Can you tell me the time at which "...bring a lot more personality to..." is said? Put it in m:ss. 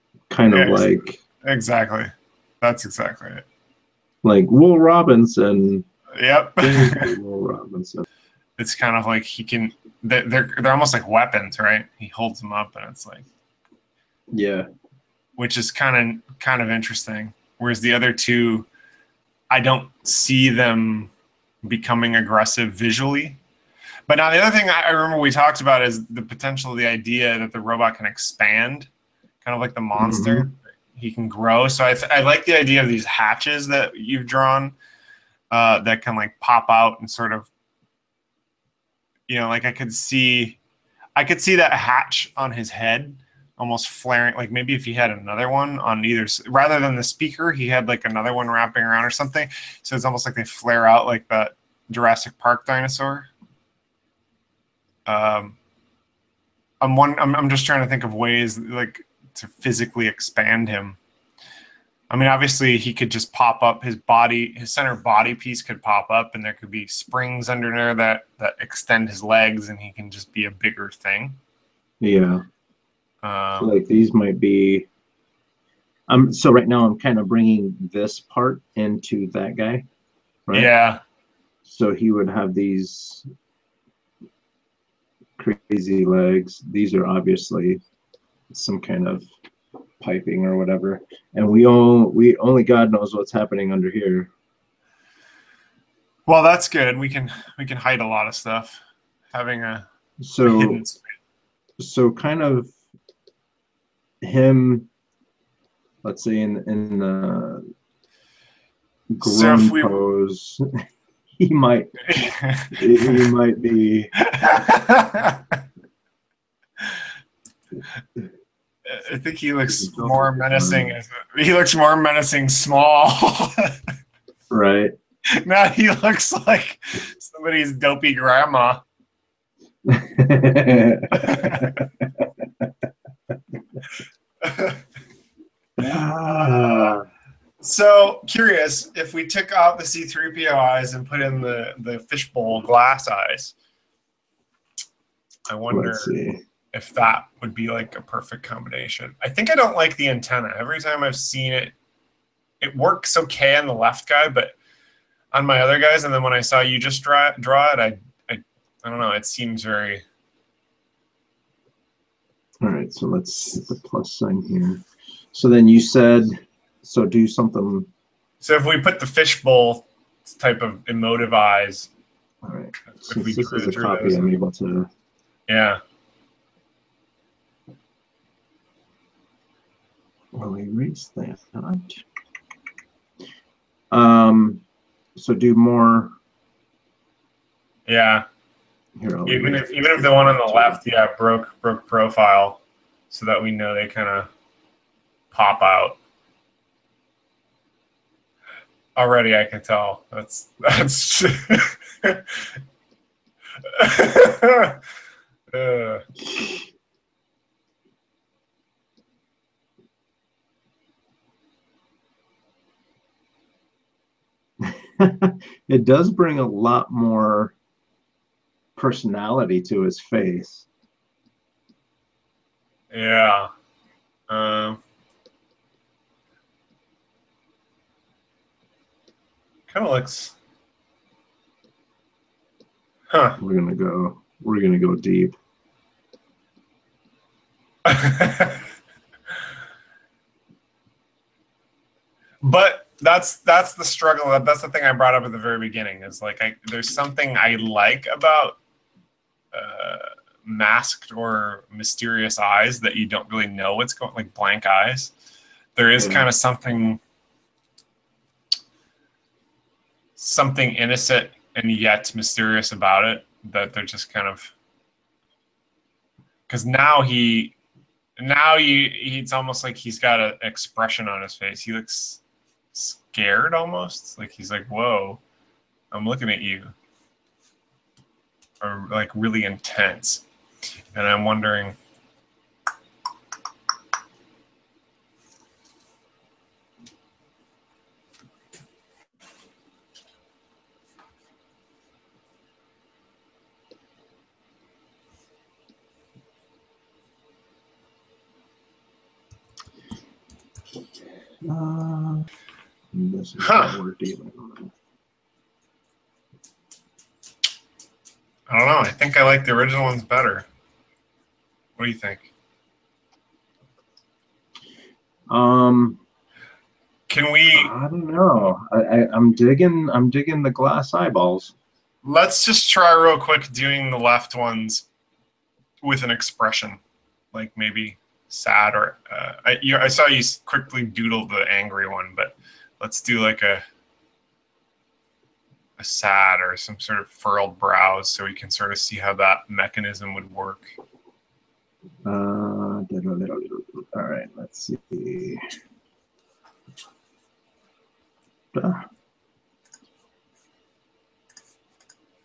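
3:36.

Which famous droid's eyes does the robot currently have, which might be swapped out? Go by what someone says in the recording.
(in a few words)
C3PO.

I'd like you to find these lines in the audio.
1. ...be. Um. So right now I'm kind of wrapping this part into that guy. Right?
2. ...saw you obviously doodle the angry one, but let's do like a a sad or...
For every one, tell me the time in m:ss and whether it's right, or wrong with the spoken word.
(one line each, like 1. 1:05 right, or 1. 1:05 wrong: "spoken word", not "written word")
1. 1:14 wrong: "bringing", not "wrapping"
2. 5:29 wrong: "quickly", not "obviously".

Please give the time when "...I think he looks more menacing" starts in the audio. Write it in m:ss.
1:59.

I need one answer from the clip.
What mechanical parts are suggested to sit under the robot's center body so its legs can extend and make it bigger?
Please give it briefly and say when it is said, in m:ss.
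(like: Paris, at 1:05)
springs, at 1:06.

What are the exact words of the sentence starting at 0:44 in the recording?
Like maybe if he had another one on either, rather than the speaker, he had like another one wrapping around or something.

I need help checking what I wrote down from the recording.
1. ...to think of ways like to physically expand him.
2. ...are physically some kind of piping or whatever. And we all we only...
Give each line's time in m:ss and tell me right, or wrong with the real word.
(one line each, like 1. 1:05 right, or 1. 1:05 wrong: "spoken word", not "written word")
1. 0:57 right
2. 1:26 wrong: "obviously", not "physically".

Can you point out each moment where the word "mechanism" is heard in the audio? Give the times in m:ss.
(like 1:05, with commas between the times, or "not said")
5:39.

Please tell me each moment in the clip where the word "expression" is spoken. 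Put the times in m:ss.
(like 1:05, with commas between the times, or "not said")
4:30, 5:26.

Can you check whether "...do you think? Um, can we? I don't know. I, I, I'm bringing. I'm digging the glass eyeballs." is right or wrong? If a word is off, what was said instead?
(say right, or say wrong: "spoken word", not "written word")
wrong: "digging", not "bringing".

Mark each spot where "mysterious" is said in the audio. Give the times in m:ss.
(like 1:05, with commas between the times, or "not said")
4:11, 4:22.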